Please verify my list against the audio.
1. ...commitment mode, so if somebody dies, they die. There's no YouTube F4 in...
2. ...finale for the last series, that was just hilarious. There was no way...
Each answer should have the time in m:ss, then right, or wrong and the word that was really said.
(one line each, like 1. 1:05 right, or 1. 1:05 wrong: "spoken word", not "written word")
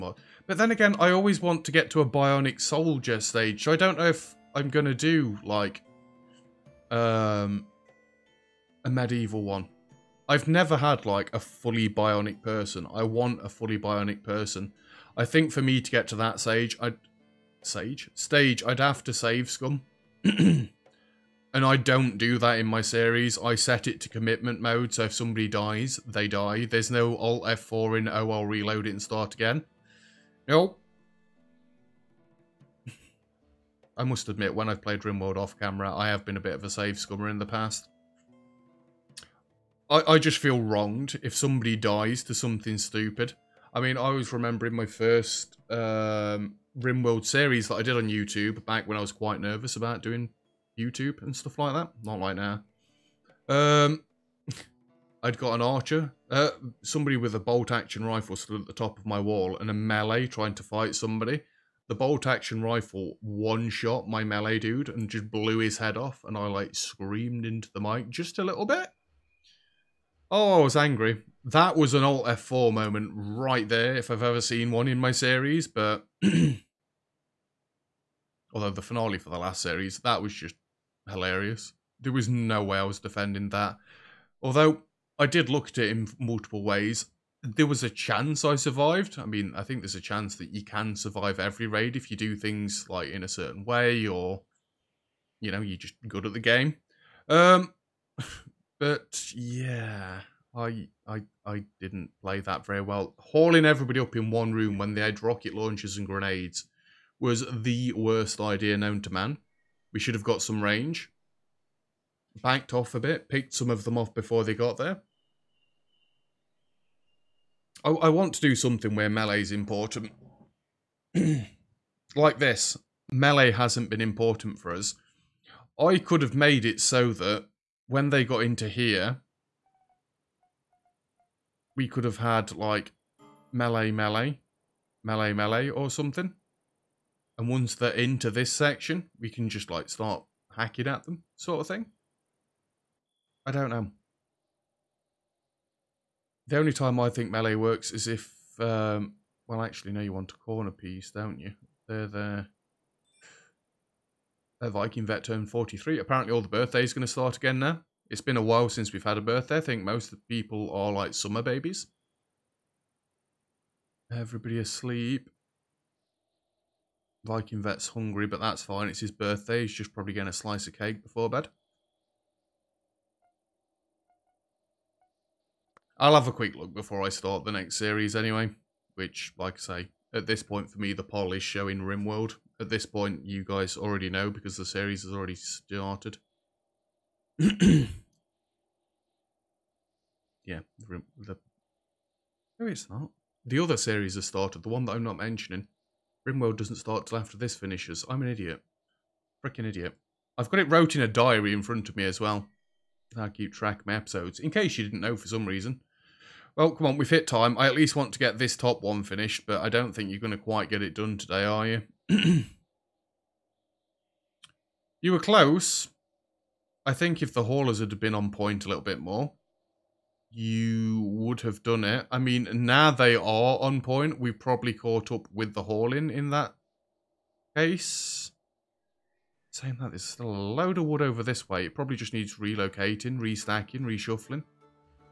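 1. 0:24 wrong: "Alt", not "YouTube"
2. 1:18 right.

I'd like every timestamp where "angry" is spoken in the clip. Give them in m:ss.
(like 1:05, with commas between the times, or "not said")
1:10.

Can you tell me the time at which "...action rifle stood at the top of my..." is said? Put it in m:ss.
0:57.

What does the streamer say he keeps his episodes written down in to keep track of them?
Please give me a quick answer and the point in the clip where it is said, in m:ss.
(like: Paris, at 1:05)
a diary, at 3:21.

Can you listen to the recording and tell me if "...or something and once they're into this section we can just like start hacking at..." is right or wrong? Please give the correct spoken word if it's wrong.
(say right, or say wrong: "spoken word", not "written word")
right.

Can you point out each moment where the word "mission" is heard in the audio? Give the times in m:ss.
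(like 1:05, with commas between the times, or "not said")
not said.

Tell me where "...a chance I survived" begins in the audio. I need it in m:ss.
1:27.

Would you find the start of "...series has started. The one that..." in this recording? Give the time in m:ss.
3:13.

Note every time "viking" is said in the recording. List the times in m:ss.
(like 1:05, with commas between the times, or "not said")
2:34, 2:47.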